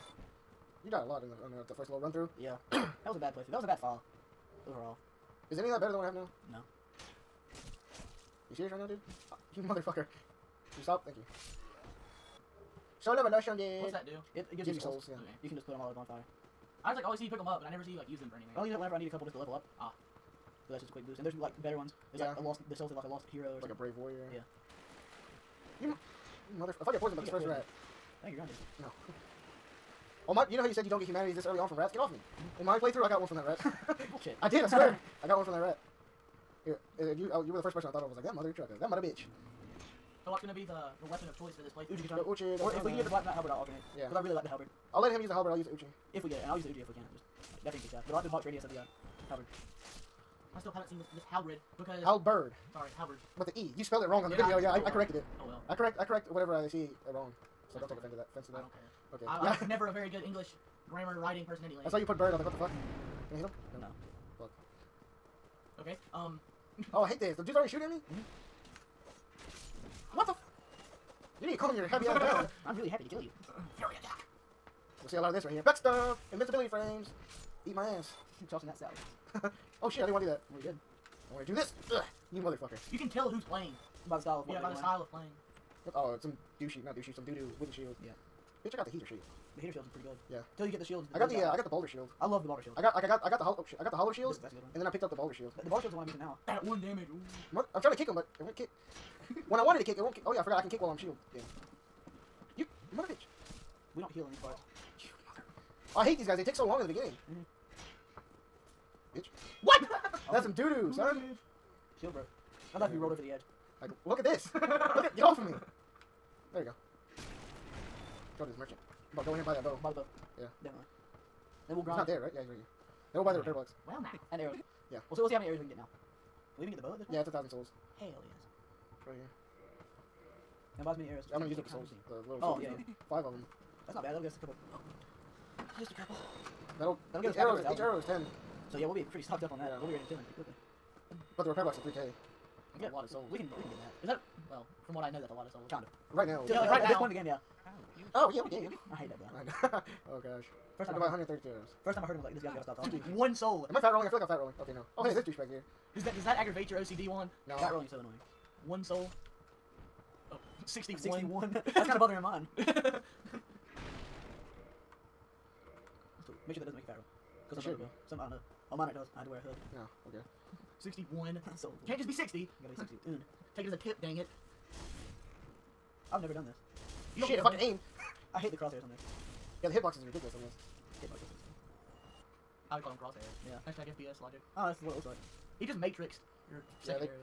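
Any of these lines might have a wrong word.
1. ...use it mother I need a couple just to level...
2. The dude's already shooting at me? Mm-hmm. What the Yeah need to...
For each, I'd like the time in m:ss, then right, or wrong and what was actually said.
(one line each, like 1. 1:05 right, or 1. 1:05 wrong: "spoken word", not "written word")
1. 0:18 wrong: "whenever", not "mother"
2. 1:07 wrong: "You", not "Yeah".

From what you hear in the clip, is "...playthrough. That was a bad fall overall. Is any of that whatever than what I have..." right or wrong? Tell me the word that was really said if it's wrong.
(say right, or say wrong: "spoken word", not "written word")
wrong: "better", not "whatever".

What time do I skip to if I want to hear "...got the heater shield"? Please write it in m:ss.
1:28.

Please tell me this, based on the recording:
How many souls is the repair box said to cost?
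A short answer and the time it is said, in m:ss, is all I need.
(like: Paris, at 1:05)
3000, at 2:21.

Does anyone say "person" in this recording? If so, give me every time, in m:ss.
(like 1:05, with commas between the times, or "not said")
0:37, 1:01.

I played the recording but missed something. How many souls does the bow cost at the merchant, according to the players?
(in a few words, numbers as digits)
1000.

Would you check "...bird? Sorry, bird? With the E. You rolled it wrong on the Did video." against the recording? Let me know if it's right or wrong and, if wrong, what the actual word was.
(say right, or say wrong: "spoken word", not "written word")
wrong: "spelled", not "rolled".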